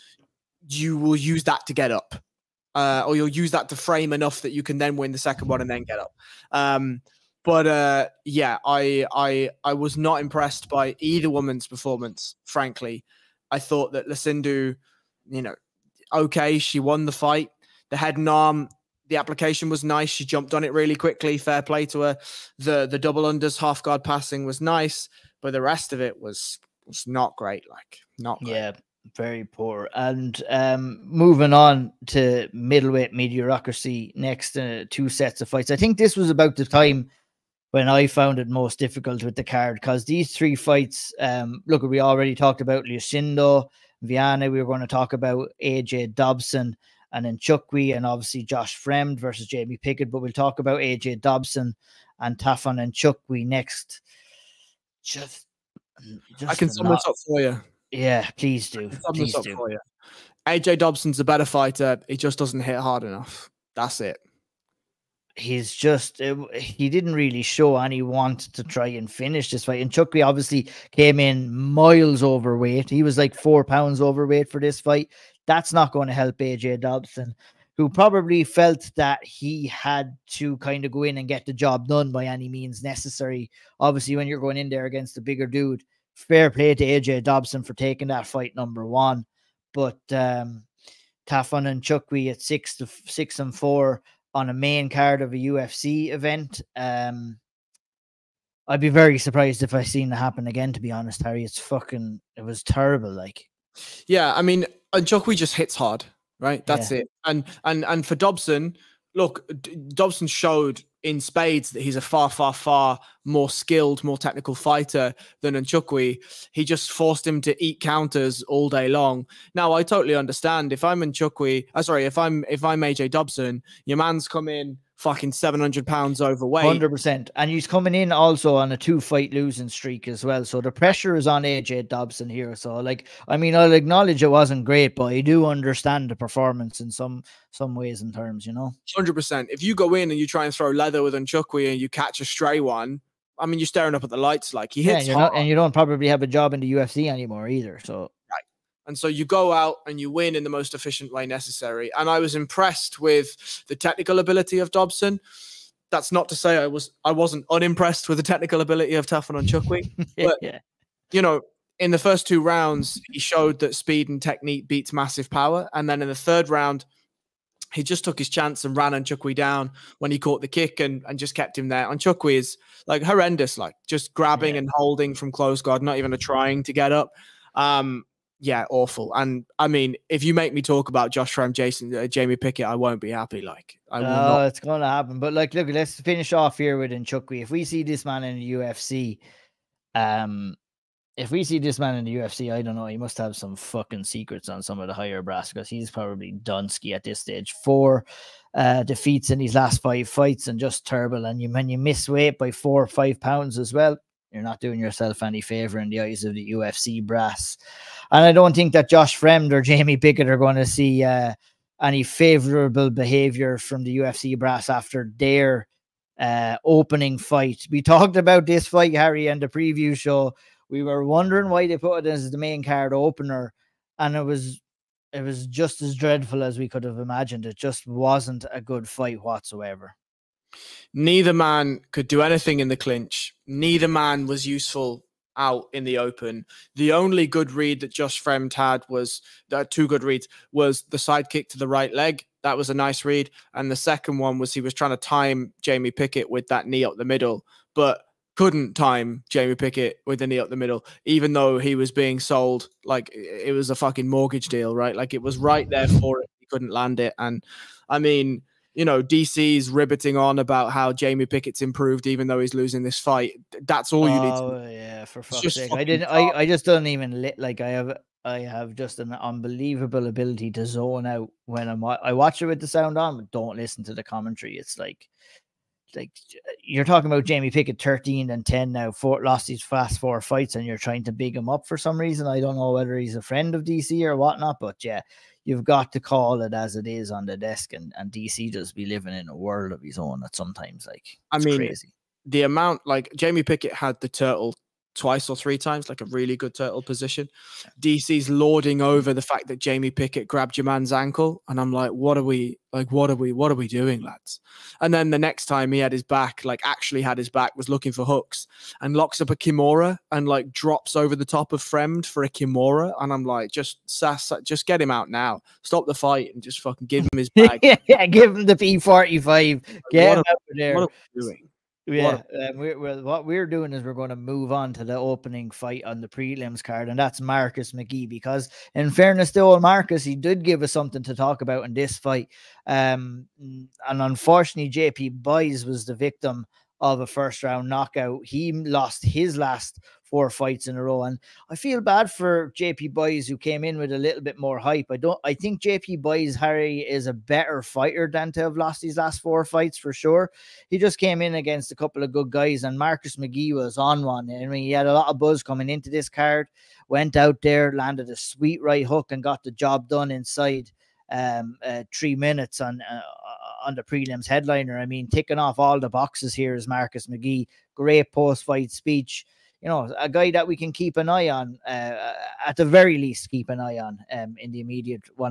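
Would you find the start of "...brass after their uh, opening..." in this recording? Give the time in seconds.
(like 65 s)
214 s.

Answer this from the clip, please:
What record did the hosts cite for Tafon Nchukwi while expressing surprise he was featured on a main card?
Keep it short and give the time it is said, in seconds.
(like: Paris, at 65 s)
6-6, at 92 s.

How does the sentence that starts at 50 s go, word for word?
But we'll talk about AJ Dobson and Tafon Nchukwi next.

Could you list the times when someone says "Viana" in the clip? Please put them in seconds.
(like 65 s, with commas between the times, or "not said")
44 s.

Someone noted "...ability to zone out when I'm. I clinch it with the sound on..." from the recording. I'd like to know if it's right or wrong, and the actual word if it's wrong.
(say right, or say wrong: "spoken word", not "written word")
wrong: "watch", not "clinch".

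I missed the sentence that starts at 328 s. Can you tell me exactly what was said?
Because in fairness to old Marcus, he did give us something to talk about in this fight.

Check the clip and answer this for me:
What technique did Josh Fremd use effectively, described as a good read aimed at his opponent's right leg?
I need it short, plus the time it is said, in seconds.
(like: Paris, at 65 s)
Sidekick, at 240 s.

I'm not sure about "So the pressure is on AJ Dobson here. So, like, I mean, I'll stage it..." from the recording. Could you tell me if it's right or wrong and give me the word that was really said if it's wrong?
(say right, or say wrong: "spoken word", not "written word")
wrong: "acknowledge", not "stage".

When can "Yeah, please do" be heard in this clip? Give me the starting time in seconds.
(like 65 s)
57 s.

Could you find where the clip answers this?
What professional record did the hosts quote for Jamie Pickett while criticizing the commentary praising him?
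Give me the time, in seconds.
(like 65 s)
277 s.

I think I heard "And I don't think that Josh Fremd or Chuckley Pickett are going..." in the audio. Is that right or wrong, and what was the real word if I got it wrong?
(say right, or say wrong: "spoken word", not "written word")
wrong: "Jamie", not "Chuckley".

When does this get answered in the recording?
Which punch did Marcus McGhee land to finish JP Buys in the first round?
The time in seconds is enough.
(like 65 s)
358 s.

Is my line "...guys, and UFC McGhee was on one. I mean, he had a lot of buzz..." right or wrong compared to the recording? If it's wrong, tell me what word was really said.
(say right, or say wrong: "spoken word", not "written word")
wrong: "Marcus", not "UFC".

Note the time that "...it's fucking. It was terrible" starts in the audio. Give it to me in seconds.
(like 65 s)
101 s.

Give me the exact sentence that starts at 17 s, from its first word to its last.
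The head and arm, the application was nice.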